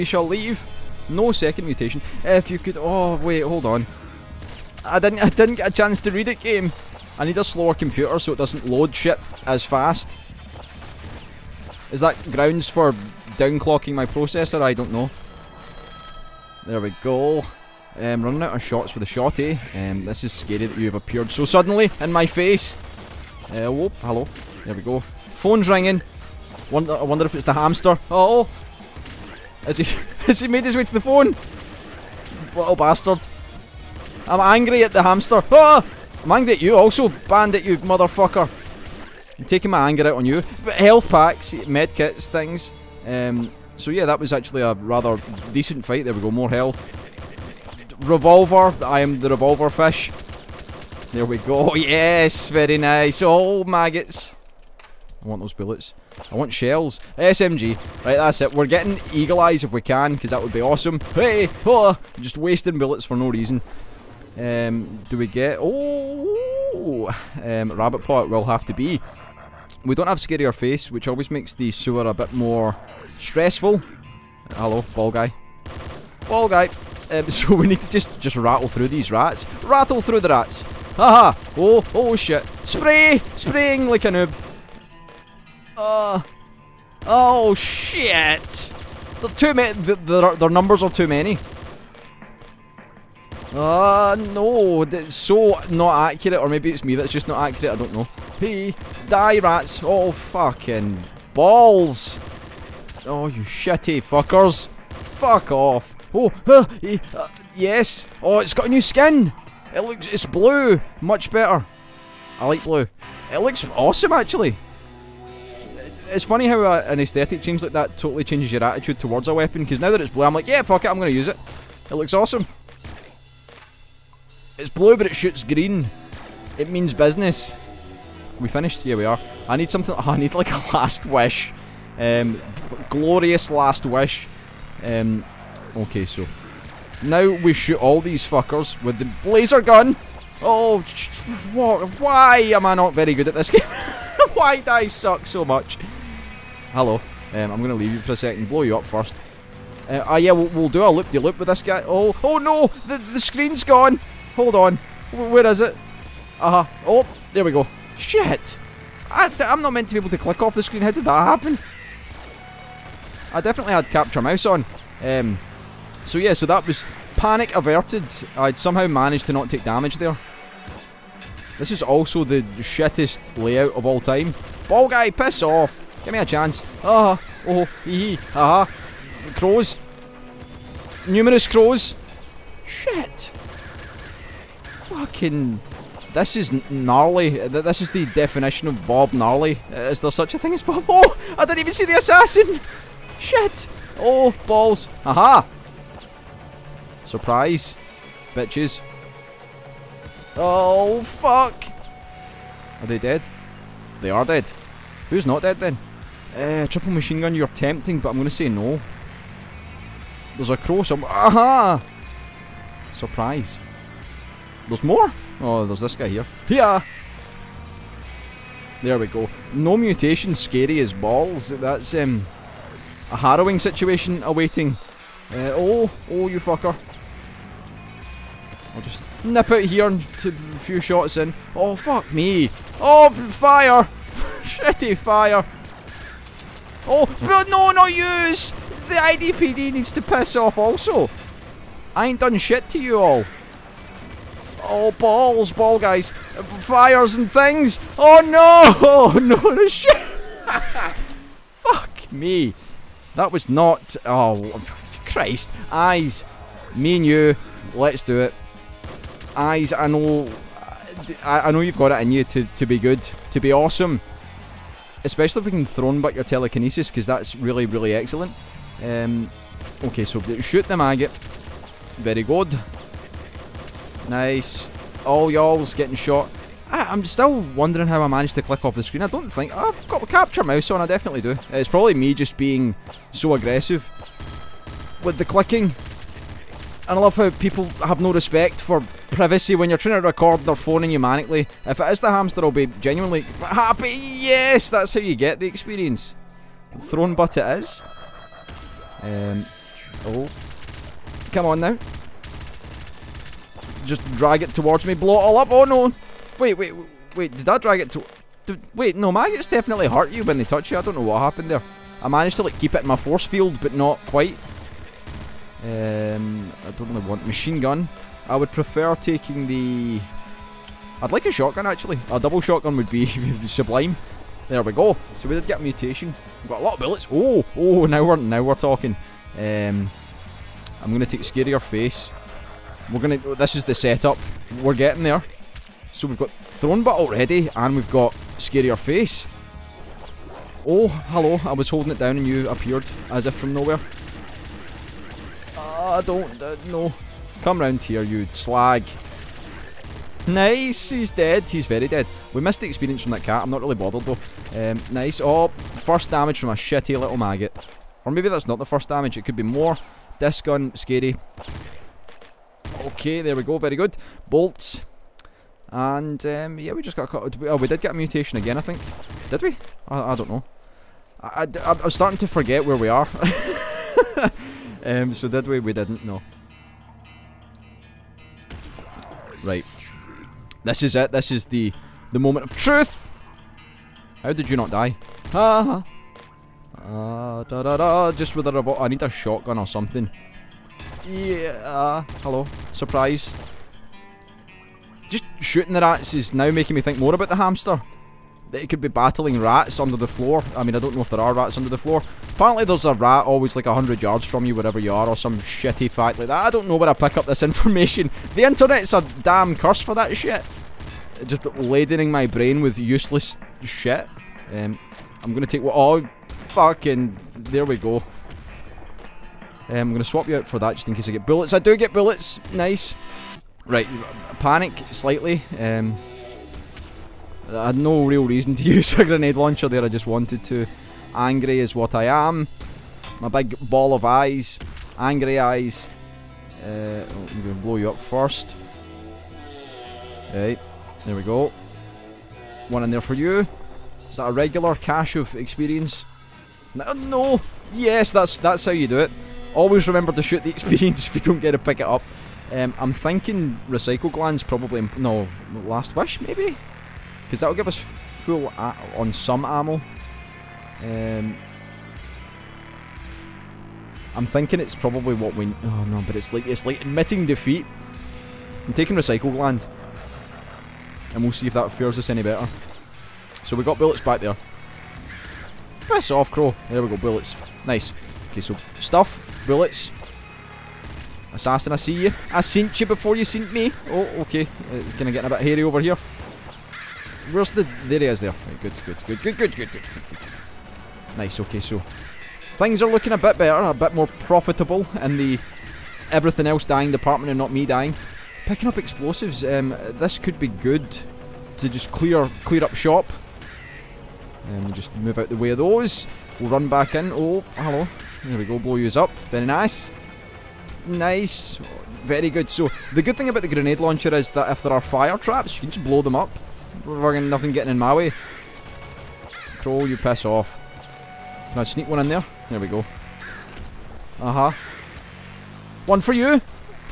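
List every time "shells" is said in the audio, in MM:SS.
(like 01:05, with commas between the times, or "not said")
00:56.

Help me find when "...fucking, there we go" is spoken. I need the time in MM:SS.
06:56.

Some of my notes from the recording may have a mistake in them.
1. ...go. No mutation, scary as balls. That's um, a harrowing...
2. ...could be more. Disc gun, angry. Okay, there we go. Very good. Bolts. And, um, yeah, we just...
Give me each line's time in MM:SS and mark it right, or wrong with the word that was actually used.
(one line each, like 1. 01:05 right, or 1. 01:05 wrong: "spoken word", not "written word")
1. 03:39 right
2. 05:59 wrong: "scary", not "angry".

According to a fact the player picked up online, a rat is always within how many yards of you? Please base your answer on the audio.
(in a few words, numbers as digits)
100 yards.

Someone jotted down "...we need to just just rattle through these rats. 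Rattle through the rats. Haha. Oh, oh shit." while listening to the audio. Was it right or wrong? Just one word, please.
right.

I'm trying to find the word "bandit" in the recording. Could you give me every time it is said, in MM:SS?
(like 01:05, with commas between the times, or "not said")
00:37.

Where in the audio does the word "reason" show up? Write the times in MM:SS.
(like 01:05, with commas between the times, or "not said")
01:03, 07:08.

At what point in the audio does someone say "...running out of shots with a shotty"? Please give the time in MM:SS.
00:18.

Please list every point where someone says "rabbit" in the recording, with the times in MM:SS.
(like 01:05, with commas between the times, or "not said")
01:07.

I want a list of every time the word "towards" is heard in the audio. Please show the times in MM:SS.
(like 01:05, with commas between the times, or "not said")
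01:58, 05:04.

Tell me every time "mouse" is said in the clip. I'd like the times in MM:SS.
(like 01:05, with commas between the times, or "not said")
02:44, 04:40.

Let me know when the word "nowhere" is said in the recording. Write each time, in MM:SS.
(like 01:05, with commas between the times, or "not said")
05:43.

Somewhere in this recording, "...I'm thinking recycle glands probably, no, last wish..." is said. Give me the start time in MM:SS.
07:32.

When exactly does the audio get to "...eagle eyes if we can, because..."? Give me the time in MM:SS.
00:59.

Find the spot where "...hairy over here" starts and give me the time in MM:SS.
08:05.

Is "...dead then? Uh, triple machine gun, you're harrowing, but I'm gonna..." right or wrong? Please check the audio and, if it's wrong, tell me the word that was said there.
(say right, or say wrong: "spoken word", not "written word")
wrong: "tempting", not "harrowing".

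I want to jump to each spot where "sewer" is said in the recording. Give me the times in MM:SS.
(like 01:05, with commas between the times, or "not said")
01:11.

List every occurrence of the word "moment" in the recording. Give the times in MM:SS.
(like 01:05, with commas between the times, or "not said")
06:22.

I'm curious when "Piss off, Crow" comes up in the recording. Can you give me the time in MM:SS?
07:55.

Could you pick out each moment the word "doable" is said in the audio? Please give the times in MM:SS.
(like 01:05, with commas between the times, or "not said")
not said.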